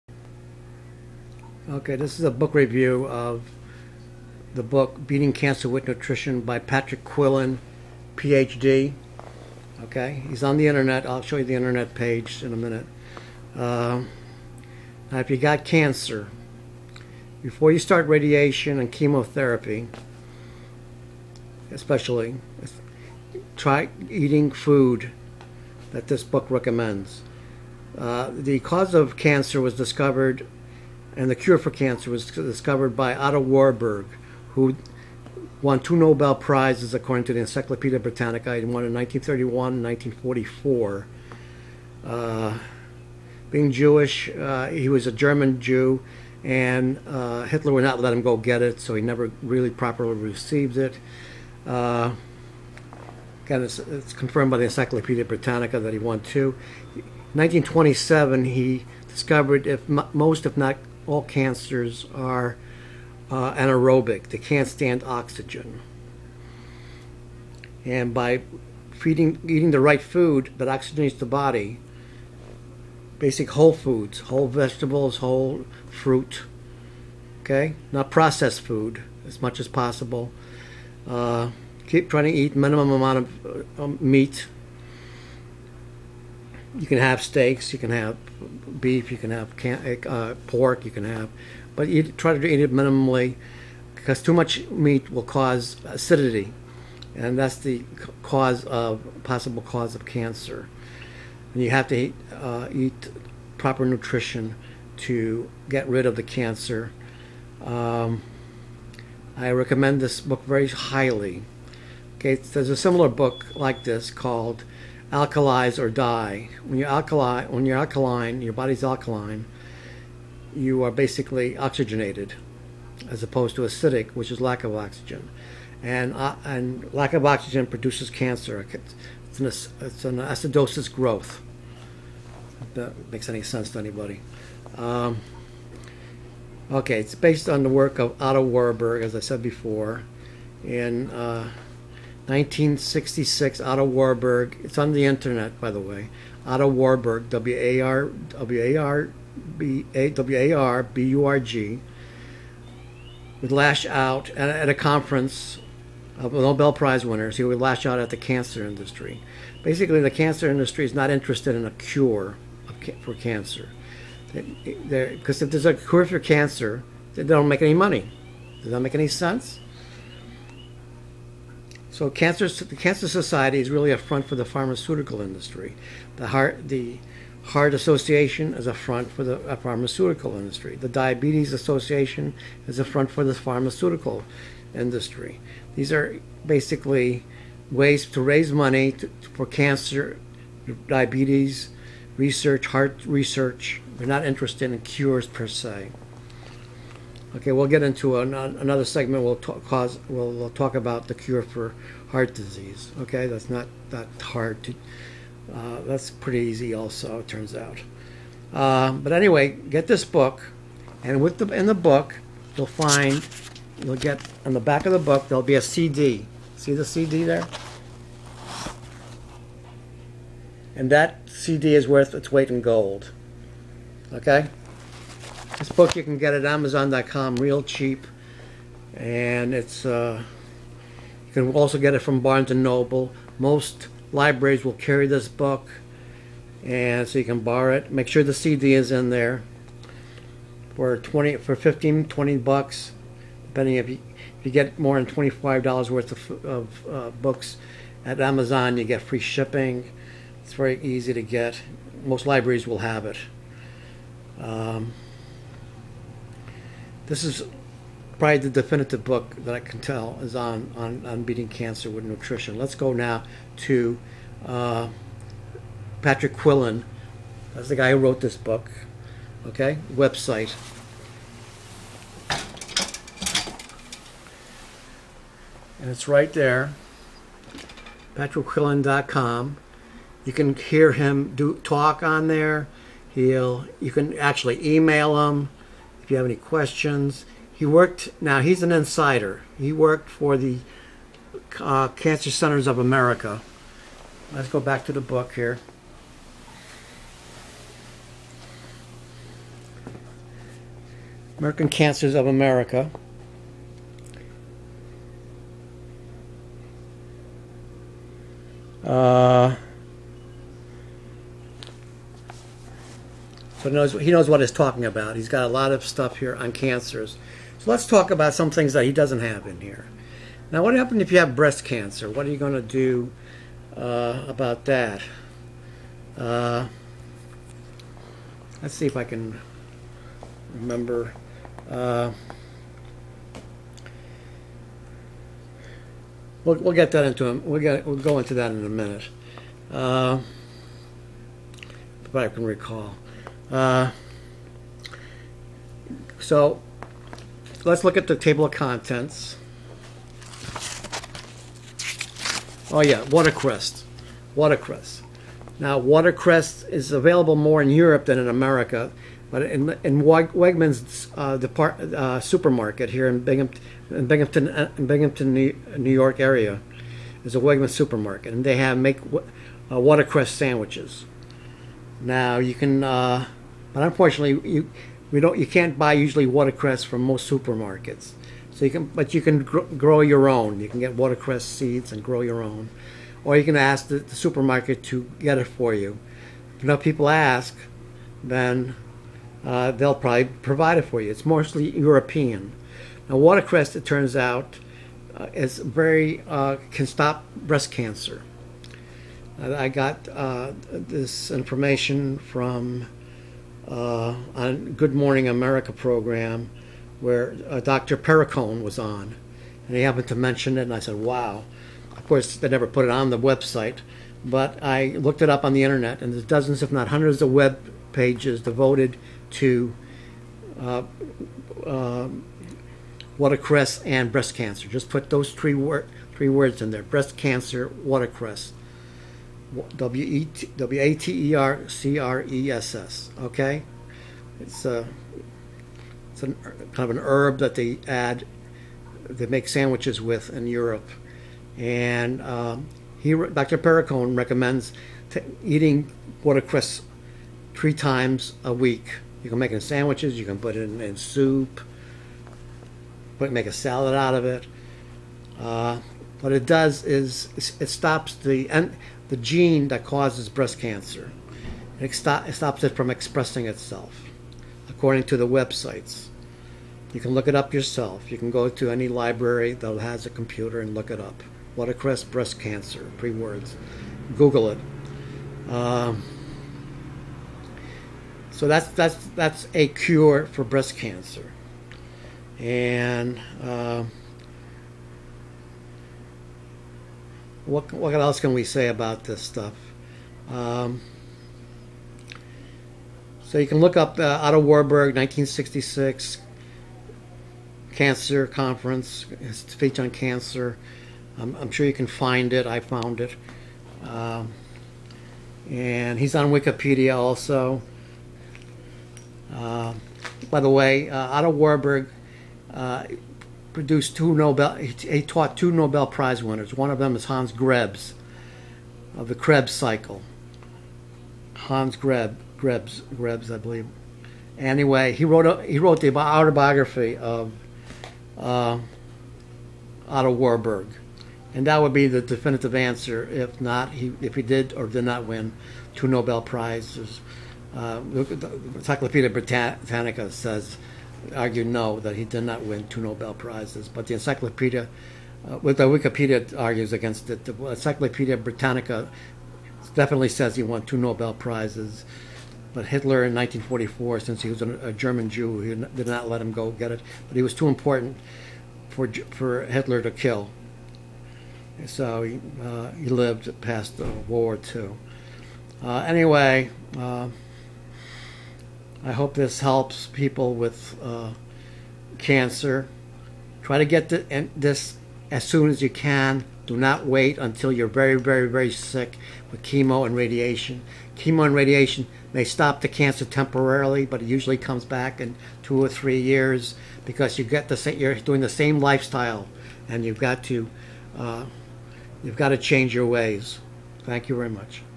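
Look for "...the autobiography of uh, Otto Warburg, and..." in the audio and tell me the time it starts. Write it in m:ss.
8:45.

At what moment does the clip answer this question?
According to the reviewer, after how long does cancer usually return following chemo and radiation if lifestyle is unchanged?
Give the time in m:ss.
9:45.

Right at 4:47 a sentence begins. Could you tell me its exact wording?
He worked, now he's an insider.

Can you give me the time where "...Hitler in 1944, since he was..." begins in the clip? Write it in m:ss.
9:12.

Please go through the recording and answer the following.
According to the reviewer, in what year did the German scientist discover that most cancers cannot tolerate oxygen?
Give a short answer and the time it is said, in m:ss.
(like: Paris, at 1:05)
1927, at 0:57.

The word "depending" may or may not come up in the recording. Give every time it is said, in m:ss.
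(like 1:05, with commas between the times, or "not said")
4:03.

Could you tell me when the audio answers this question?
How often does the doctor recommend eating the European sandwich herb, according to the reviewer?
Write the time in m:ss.
7:27.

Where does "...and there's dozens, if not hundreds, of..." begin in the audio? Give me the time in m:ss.
6:56.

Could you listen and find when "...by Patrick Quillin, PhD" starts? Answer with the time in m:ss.
0:06.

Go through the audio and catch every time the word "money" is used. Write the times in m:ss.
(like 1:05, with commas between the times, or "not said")
2:47, 3:08.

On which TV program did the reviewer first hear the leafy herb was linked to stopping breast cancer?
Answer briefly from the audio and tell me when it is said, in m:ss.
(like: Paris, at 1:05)
Good Morning America, at 6:44.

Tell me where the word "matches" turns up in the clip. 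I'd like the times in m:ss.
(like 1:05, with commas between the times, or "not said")
not said.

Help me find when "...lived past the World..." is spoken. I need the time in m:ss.
9:22.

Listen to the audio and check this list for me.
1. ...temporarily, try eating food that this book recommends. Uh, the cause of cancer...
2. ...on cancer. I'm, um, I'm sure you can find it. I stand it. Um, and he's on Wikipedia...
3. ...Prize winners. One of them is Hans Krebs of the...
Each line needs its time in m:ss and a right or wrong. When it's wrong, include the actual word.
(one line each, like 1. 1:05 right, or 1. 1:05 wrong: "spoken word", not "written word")
1. 0:21 wrong: "especially", not "temporarily"
2. 8:19 wrong: "found", not "stand"
3. 8:35 right.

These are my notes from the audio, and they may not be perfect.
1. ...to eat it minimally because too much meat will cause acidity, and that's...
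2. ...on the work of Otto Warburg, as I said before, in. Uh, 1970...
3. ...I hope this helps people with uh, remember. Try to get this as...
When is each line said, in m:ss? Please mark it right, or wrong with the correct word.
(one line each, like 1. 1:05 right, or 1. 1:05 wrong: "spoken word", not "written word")
1. 1:32 right
2. 2:17 wrong: "1966", not "1970"
3. 9:28 wrong: "cancer", not "remember".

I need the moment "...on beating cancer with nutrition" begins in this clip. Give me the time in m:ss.
4:21.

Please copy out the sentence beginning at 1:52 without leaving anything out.
Okay, there's a similar book like this called alkalize or die.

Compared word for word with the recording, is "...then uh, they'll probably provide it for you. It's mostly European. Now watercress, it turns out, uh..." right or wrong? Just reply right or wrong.
right.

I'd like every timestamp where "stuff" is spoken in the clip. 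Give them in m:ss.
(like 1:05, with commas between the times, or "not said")
5:15, 8:09.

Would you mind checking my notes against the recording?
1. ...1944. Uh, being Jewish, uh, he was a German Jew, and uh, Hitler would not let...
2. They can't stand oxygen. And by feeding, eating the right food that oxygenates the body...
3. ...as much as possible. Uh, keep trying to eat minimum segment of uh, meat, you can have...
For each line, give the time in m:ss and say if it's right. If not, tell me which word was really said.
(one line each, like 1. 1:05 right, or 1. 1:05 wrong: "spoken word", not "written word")
1. 0:39 right
2. 1:04 right
3. 1:19 wrong: "amount", not "segment".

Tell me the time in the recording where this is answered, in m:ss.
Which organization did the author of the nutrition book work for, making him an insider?
4:51.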